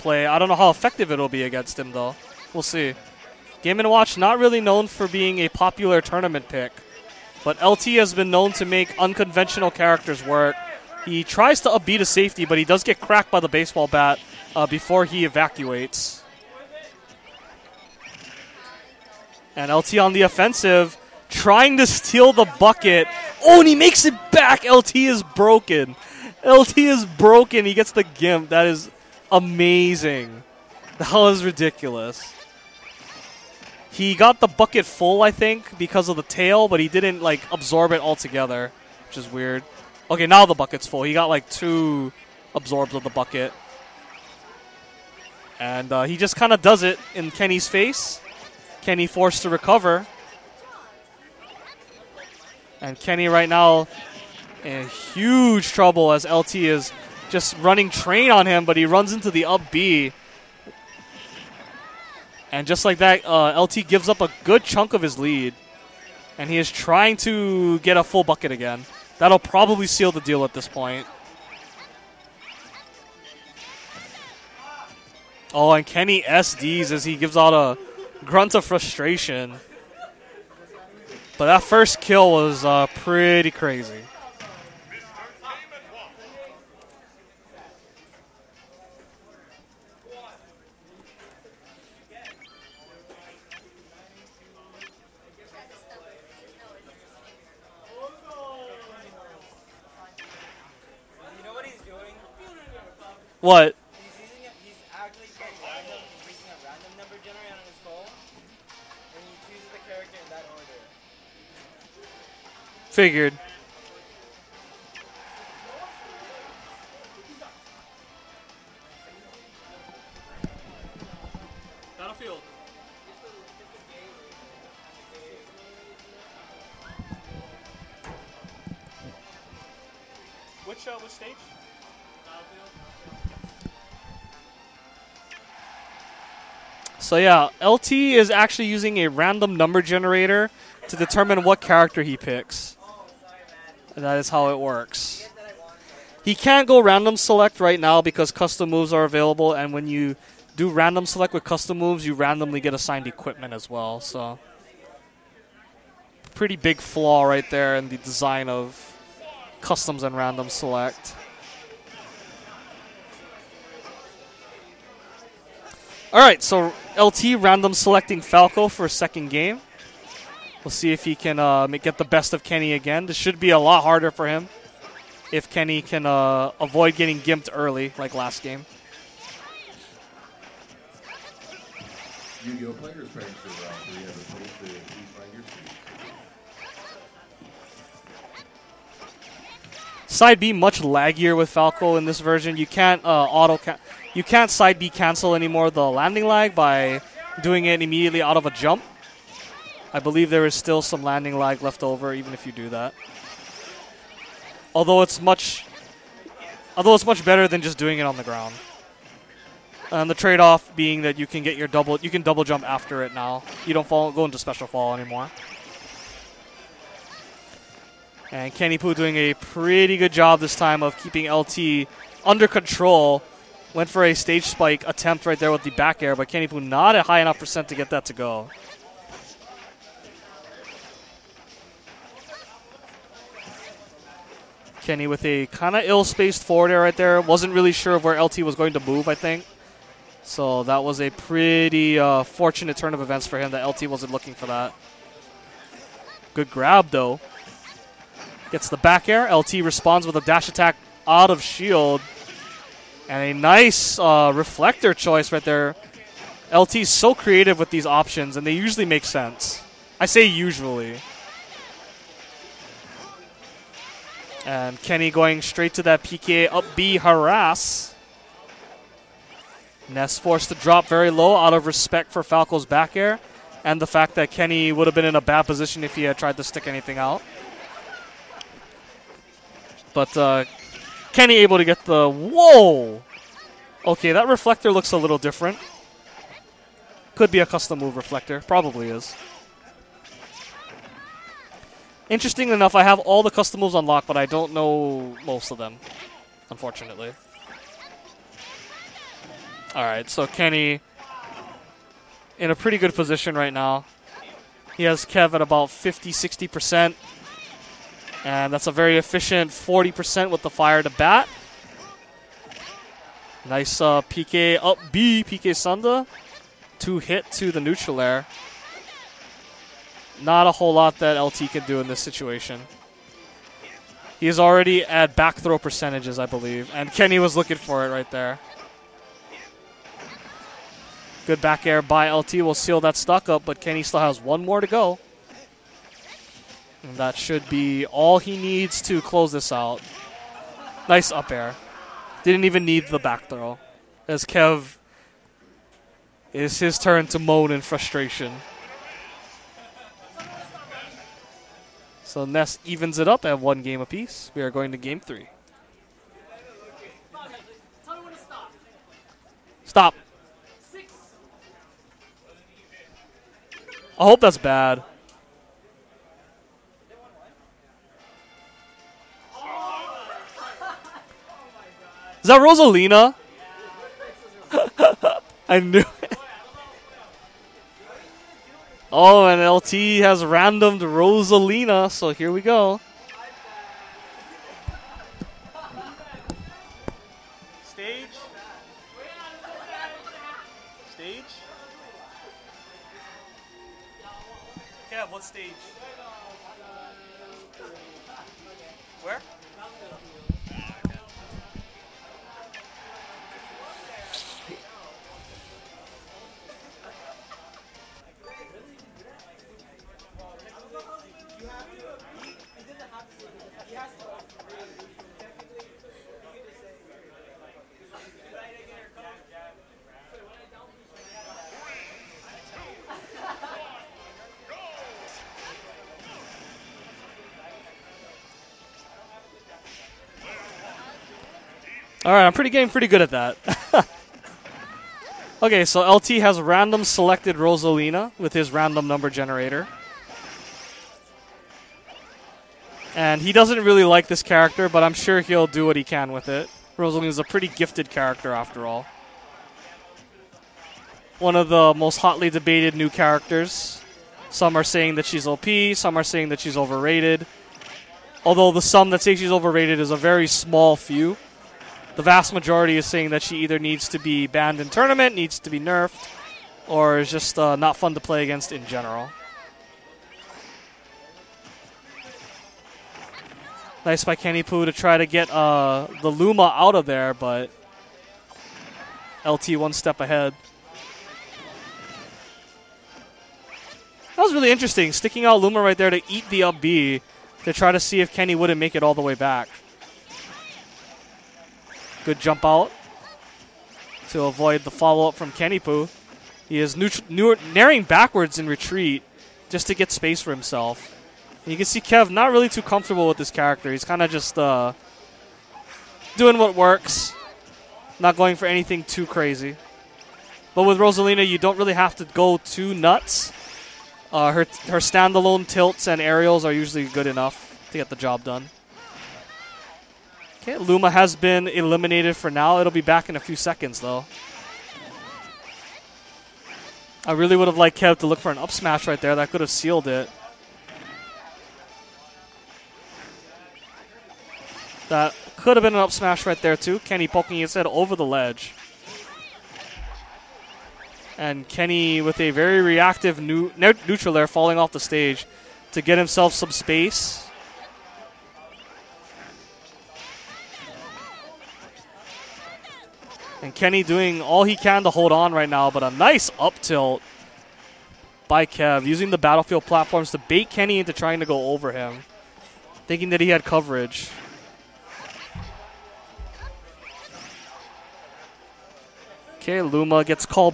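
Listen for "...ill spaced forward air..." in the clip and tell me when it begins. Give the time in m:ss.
3:55.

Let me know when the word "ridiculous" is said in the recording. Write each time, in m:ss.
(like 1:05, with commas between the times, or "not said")
0:31.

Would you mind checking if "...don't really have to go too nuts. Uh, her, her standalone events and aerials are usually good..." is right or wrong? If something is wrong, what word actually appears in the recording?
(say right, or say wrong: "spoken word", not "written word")
wrong: "tilts", not "events".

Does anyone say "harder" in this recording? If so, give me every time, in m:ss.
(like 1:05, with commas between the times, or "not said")
2:53.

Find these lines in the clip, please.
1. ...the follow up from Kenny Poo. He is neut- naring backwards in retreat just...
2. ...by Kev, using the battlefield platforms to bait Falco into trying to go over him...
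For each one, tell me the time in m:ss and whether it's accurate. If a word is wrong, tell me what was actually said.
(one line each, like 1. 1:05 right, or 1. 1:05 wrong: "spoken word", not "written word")
1. 8:14 right
2. 9:18 wrong: "Kenny", not "Falco".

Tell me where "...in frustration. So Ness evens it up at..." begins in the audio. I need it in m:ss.
5:47.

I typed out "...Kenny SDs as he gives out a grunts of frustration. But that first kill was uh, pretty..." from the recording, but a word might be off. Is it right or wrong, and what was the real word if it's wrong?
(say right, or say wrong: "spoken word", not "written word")
right.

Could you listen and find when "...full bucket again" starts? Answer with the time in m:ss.
1:08.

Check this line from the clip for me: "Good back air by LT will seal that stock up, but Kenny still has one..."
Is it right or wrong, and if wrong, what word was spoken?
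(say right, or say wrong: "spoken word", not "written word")
right.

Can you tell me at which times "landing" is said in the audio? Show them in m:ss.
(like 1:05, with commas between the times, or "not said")
3:15, 3:21.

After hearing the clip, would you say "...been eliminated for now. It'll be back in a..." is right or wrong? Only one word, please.
right.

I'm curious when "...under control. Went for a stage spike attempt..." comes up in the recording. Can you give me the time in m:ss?
3:42.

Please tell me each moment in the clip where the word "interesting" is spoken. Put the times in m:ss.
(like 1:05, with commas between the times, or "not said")
4:52, 8:04.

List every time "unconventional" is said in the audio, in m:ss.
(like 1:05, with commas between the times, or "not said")
0:08.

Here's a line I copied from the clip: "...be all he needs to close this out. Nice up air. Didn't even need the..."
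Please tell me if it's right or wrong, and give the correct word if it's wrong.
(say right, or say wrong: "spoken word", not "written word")
right.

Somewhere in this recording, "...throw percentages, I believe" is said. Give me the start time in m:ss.
5:25.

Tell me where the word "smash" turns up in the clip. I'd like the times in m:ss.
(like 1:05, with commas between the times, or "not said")
8:48, 8:55.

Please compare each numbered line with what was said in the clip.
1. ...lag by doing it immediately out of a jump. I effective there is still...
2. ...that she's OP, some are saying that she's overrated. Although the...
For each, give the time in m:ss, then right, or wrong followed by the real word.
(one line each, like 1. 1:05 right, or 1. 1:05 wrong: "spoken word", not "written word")
1. 3:16 wrong: "believe", not "effective"
2. 7:34 right.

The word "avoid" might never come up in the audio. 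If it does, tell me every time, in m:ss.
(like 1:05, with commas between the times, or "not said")
2:56, 8:14.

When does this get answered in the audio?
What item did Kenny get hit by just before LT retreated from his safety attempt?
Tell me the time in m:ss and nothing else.
0:13.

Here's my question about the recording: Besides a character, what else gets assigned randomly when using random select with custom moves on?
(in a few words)
equipment.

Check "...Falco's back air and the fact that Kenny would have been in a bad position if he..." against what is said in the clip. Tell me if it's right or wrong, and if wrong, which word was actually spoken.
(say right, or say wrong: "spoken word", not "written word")
right.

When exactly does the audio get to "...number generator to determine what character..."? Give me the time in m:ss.
2:19.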